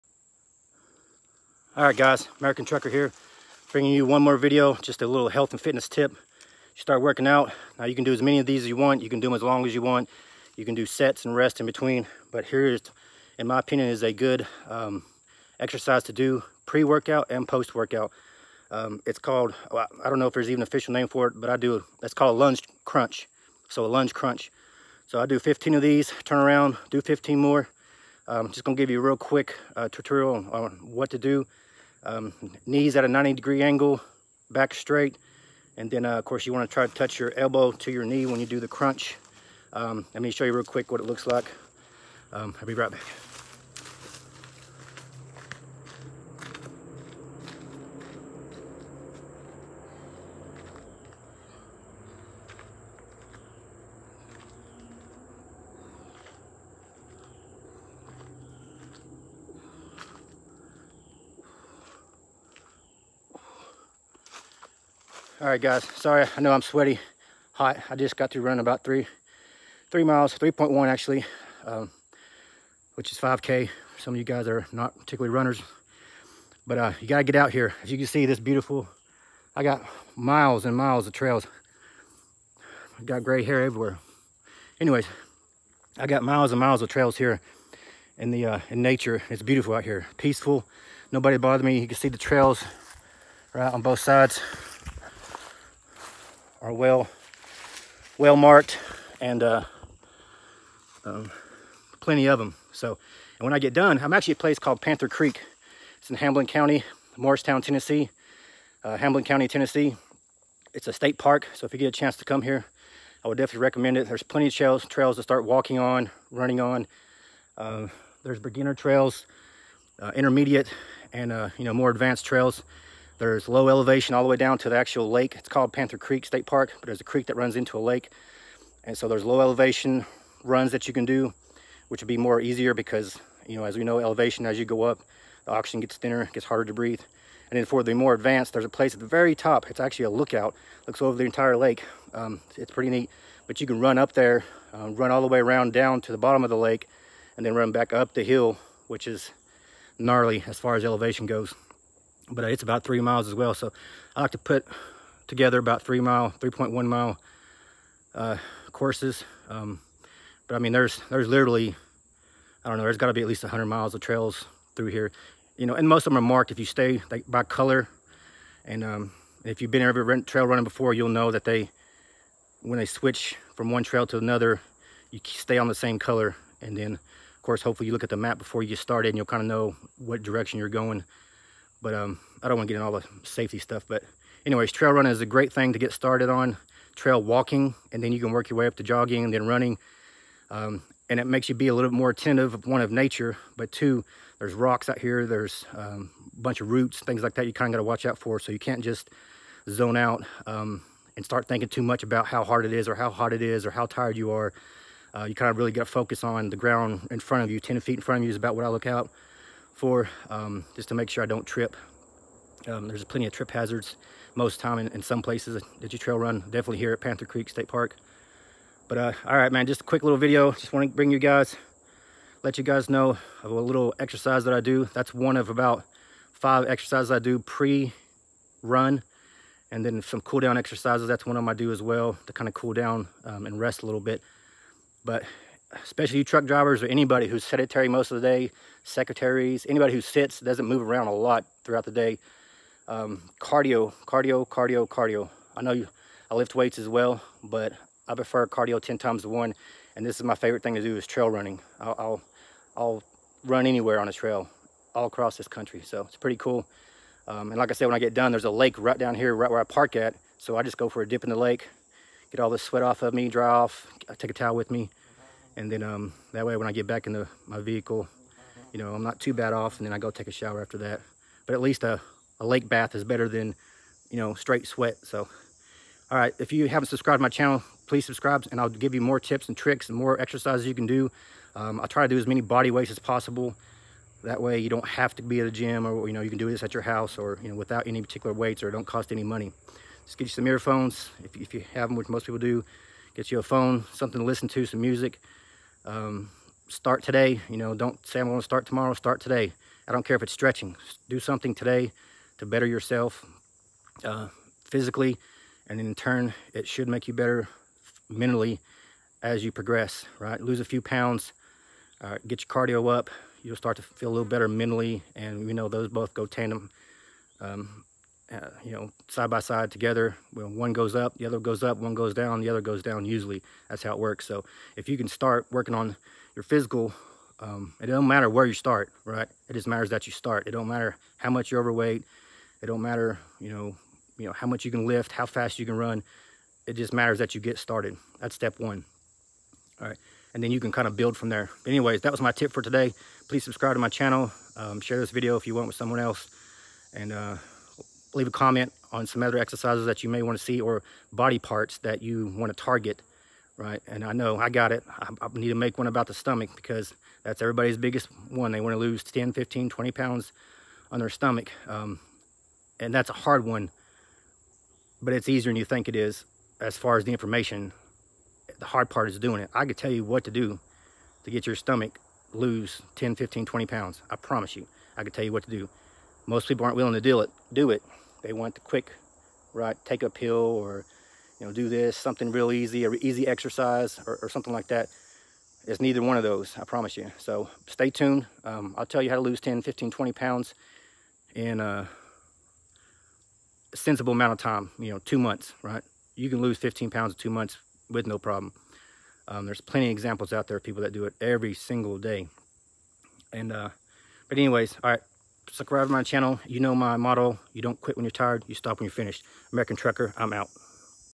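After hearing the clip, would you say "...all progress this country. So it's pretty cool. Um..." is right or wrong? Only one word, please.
wrong.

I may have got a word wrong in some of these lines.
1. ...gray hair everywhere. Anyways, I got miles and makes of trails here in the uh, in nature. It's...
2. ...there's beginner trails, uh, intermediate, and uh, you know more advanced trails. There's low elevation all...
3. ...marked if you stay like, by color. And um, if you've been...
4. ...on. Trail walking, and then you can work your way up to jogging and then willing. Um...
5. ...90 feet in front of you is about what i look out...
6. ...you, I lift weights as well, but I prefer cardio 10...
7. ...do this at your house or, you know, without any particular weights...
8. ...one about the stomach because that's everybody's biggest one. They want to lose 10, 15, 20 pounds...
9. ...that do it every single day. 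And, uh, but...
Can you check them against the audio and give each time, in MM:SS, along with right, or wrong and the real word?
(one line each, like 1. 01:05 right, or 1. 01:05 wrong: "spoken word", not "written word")
1. 01:23 wrong: "miles", not "makes"
2. 01:58 right
3. 02:46 right
4. 03:06 wrong: "running", not "willing"
5. 03:27 wrong: "10", not "90"
6. 04:05 right
7. 04:46 right
8. 05:55 right
9. 06:40 right.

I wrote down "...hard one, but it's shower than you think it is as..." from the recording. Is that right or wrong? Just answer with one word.
wrong.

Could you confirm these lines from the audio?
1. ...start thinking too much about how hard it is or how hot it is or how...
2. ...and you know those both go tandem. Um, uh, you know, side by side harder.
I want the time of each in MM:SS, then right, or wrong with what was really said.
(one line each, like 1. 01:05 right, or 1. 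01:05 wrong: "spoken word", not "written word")
1. 03:21 right
2. 05:15 wrong: "together", not "harder".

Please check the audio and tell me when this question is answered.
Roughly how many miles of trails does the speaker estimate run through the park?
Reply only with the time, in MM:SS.
02:43.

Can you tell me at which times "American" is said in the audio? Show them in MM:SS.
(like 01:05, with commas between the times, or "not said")
00:02, 06:49.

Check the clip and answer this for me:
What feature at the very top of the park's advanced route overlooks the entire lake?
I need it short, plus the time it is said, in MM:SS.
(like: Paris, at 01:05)
A lookout, at 02:19.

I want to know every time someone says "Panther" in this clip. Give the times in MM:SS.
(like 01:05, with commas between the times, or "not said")
01:44, 02:05, 03:37.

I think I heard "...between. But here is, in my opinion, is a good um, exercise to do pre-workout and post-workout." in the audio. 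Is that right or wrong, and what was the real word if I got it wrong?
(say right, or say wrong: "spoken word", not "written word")
right.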